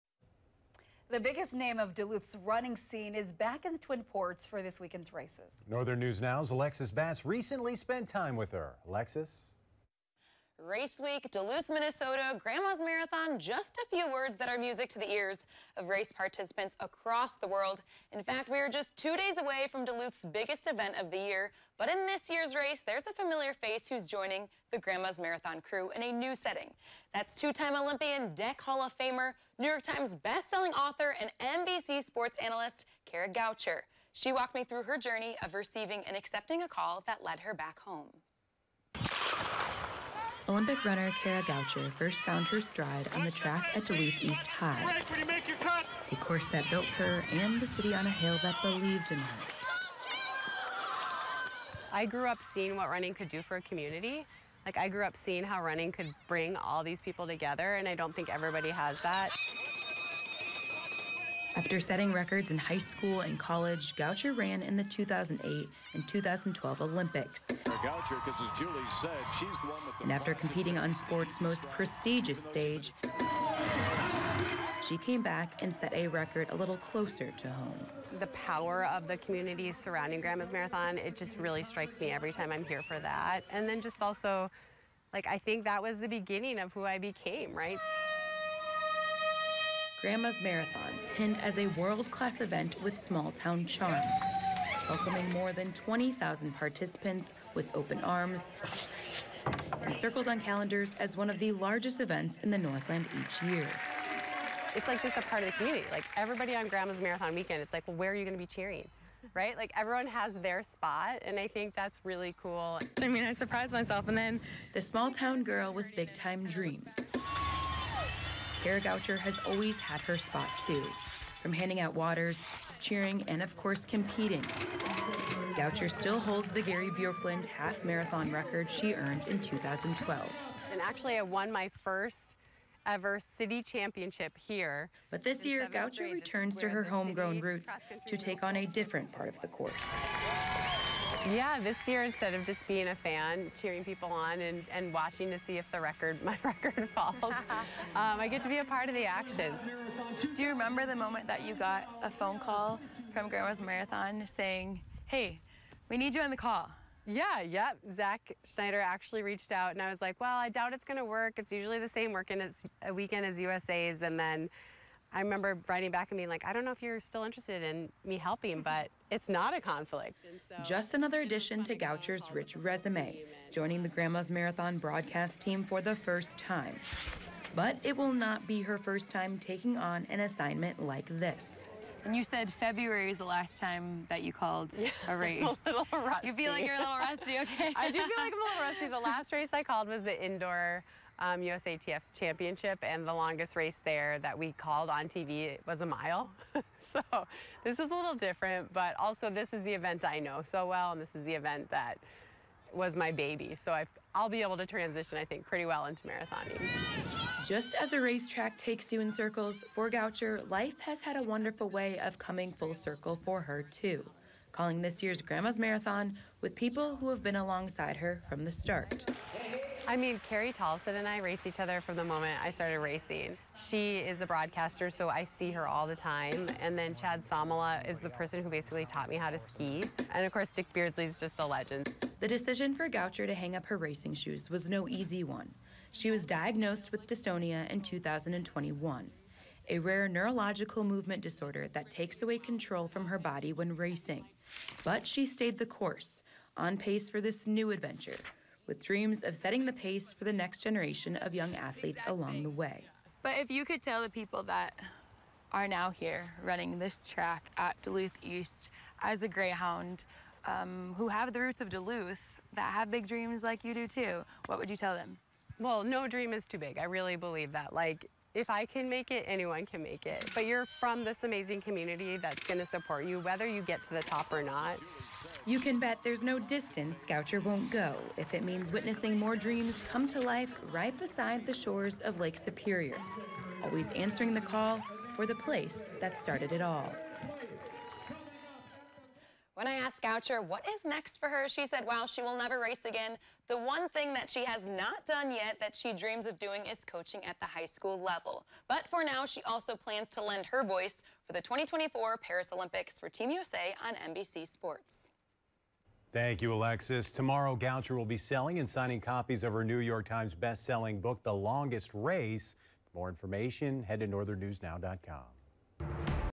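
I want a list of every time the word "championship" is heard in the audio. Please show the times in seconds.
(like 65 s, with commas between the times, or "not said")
133 s, 192 s.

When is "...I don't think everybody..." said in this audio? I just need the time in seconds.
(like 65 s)
57 s.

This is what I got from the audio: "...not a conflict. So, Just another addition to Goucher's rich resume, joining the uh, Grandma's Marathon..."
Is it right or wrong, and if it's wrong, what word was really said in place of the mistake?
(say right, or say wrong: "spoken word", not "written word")
right.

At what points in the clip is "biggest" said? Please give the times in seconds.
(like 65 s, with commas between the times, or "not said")
1 s, 20 s.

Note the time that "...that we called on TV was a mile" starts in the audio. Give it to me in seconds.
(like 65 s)
194 s.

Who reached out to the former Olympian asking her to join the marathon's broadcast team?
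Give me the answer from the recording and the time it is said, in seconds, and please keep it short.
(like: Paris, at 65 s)
Zach Schneider, at 157 s.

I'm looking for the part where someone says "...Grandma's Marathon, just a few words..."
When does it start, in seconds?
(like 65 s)
12 s.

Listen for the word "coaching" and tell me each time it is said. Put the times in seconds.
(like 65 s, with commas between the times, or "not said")
296 s.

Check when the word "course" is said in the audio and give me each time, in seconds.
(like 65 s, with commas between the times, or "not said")
46 s, 123 s, 139 s, 230 s, 245 s.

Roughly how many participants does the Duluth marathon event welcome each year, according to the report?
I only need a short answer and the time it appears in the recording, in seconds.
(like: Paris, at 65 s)
more than 20,000, at 95 s.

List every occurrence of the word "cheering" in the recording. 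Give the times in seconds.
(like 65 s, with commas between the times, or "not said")
108 s, 122 s, 143 s.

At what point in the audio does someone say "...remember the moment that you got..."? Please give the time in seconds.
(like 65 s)
150 s.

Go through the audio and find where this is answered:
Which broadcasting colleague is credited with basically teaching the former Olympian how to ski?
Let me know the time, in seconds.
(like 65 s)
226 s.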